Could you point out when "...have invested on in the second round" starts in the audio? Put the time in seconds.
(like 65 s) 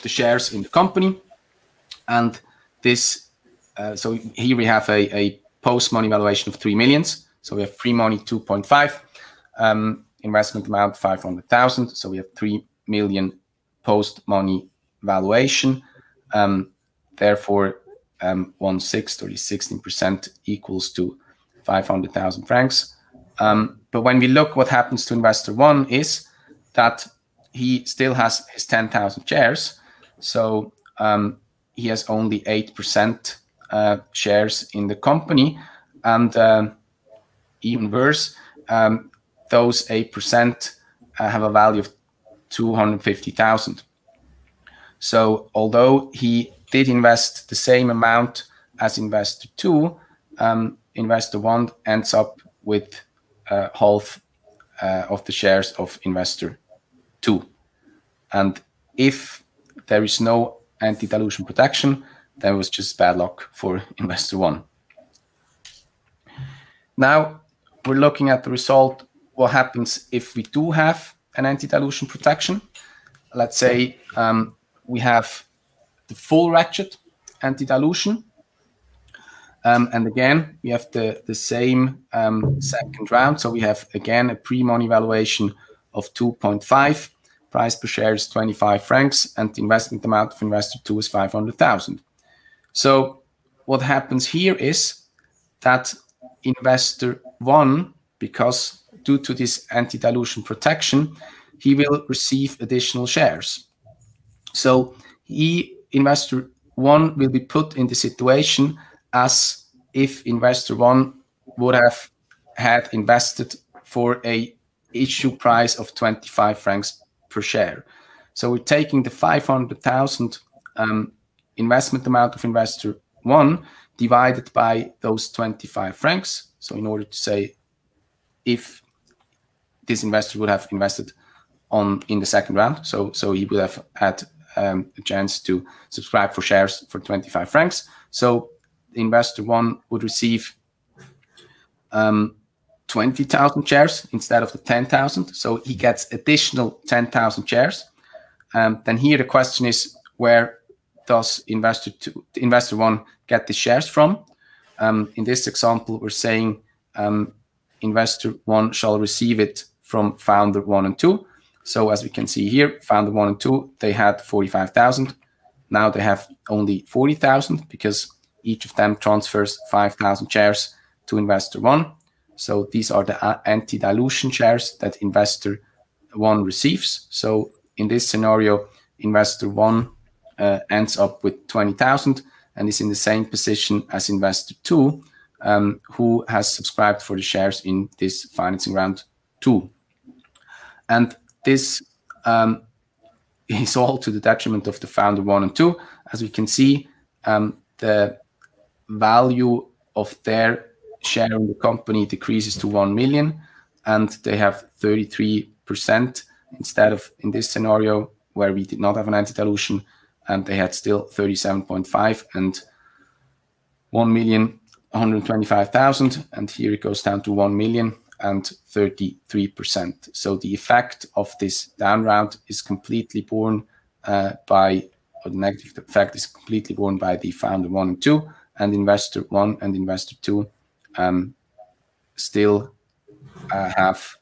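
130 s.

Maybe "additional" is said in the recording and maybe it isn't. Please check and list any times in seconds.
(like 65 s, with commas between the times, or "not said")
102 s, 146 s.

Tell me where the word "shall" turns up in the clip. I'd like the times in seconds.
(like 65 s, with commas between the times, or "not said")
158 s.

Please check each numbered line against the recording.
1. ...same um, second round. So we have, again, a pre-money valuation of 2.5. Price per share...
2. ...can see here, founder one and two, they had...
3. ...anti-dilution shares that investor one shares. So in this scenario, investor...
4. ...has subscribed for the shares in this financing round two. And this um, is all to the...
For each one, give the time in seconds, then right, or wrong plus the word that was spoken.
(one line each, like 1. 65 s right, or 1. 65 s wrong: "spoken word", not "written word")
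1. 81 s right
2. 162 s right
3. 173 s wrong: "receives", not "shares"
4. 186 s right.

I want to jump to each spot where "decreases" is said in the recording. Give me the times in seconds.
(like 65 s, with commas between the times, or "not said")
202 s.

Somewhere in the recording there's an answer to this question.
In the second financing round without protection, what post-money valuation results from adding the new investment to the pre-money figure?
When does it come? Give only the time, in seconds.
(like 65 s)
6 s.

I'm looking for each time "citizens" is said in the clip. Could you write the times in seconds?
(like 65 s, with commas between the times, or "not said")
not said.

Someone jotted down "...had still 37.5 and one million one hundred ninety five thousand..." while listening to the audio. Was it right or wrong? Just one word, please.
wrong.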